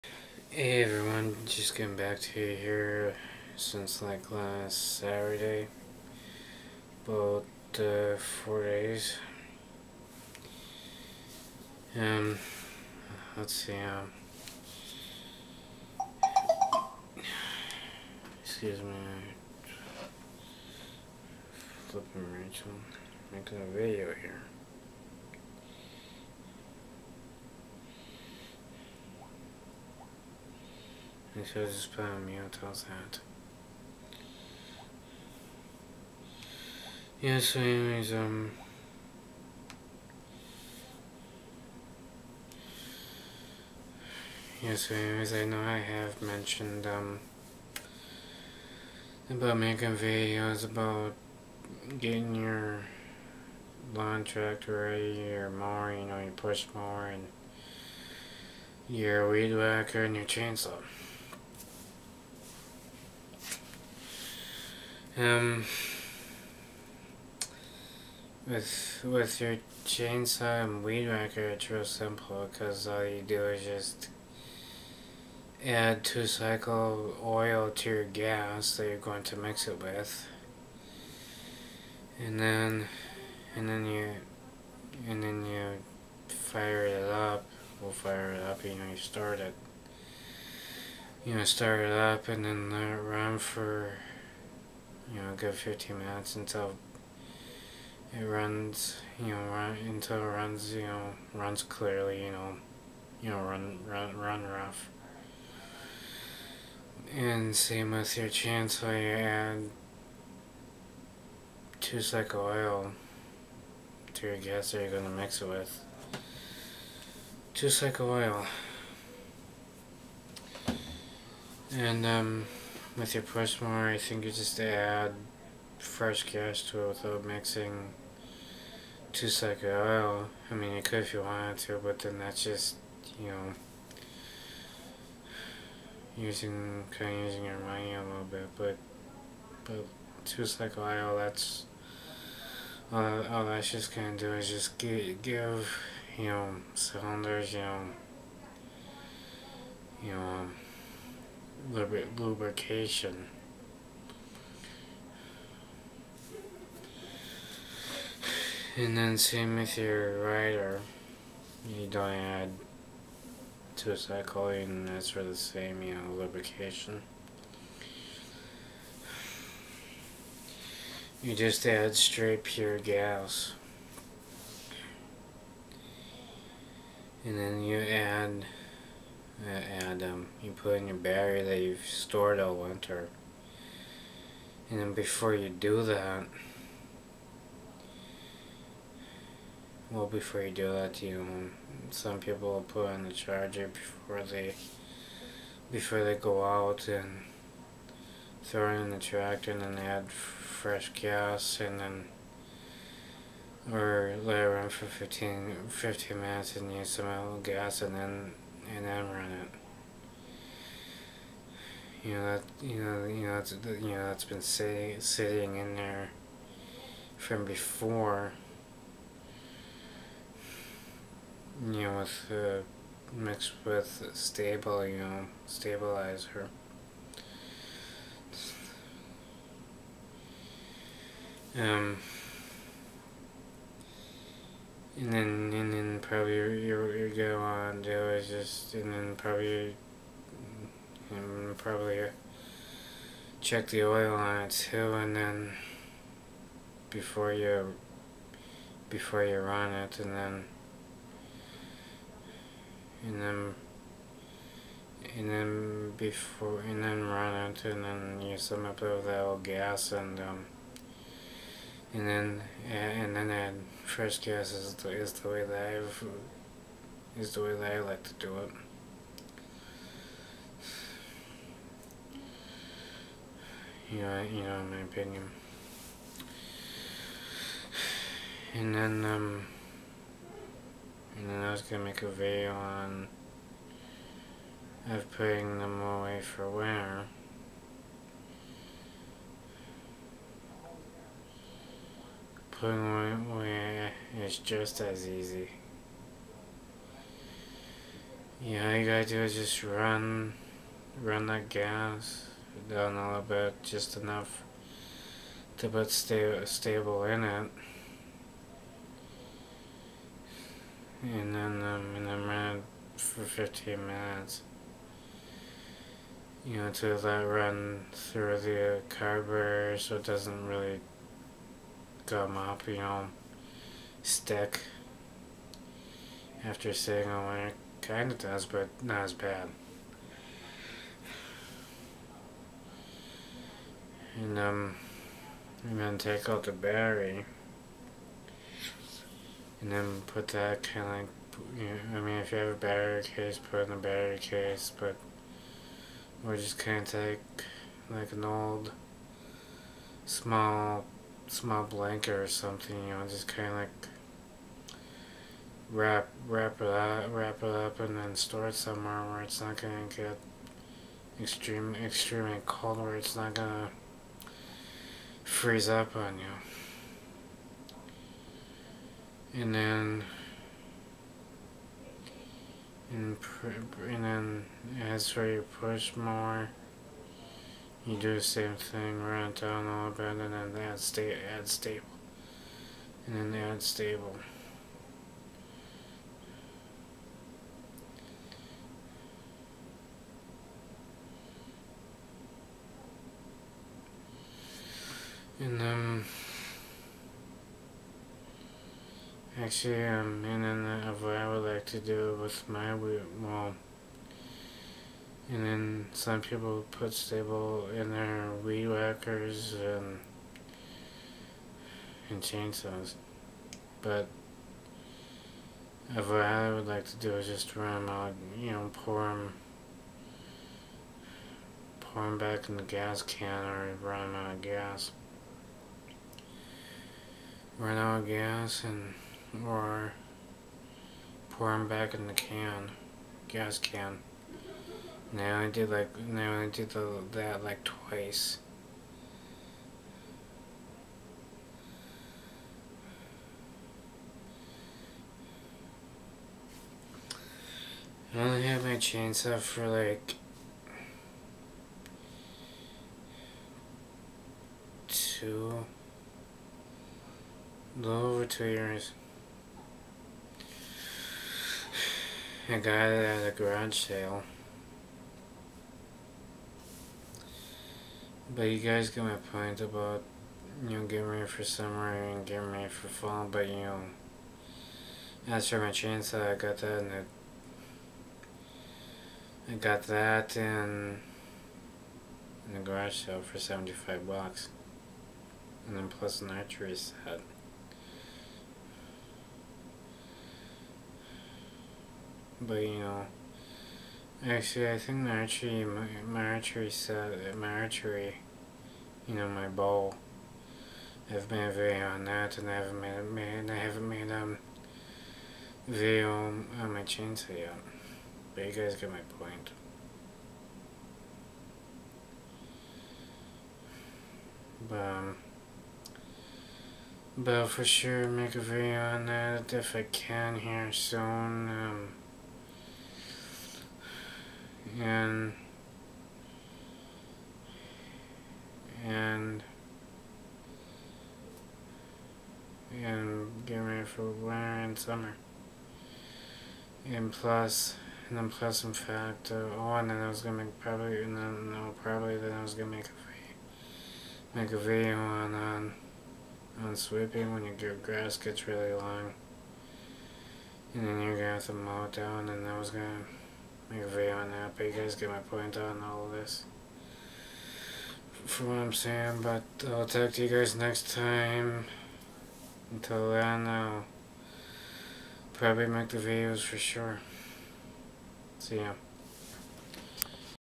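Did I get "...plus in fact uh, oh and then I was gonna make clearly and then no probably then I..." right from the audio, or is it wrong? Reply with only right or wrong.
wrong.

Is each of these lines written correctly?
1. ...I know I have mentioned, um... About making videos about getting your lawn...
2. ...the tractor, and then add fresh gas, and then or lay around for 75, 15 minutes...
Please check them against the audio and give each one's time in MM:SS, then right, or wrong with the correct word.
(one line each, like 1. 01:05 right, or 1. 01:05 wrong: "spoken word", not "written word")
1. 00:45 right
2. 03:18 wrong: "15", not "75".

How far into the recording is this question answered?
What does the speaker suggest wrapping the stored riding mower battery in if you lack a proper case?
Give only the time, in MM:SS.
05:50.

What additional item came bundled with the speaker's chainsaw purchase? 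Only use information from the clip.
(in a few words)
archery set.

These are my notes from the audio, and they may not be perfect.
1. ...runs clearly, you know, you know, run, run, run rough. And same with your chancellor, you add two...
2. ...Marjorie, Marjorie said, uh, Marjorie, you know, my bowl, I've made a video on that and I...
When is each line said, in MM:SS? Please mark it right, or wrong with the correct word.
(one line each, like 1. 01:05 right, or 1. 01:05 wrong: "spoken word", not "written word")
1. 01:41 right
2. 08:14 right.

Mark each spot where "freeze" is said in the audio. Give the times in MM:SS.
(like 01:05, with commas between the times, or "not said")
06:05.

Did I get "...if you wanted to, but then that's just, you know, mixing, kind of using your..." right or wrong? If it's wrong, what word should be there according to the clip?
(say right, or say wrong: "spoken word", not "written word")
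wrong: "using", not "mixing".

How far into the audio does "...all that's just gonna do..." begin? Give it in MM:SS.
02:23.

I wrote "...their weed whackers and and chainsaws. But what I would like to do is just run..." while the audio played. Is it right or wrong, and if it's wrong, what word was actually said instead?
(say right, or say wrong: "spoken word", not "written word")
right.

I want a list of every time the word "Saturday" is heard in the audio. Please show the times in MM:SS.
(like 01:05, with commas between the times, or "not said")
00:04.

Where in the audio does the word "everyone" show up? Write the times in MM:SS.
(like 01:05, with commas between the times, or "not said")
00:00.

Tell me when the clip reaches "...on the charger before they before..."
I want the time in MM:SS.
03:12.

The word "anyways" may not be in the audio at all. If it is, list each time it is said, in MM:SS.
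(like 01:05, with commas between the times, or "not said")
00:37, 00:44.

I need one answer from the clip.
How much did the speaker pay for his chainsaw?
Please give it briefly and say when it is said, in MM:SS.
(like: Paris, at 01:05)
$75, at 08:03.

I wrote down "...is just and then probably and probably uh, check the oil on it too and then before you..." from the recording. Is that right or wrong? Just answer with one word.
right.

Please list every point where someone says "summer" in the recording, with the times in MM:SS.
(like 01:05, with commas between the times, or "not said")
07:51, 08:54.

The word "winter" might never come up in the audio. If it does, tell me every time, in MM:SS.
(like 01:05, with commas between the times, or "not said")
03:02, 04:46, 08:54.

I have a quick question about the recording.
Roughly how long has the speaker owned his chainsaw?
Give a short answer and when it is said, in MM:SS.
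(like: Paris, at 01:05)
a little over 2 years, at 07:37.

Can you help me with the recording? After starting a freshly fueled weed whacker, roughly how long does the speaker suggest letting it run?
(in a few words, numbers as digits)
15 minutes.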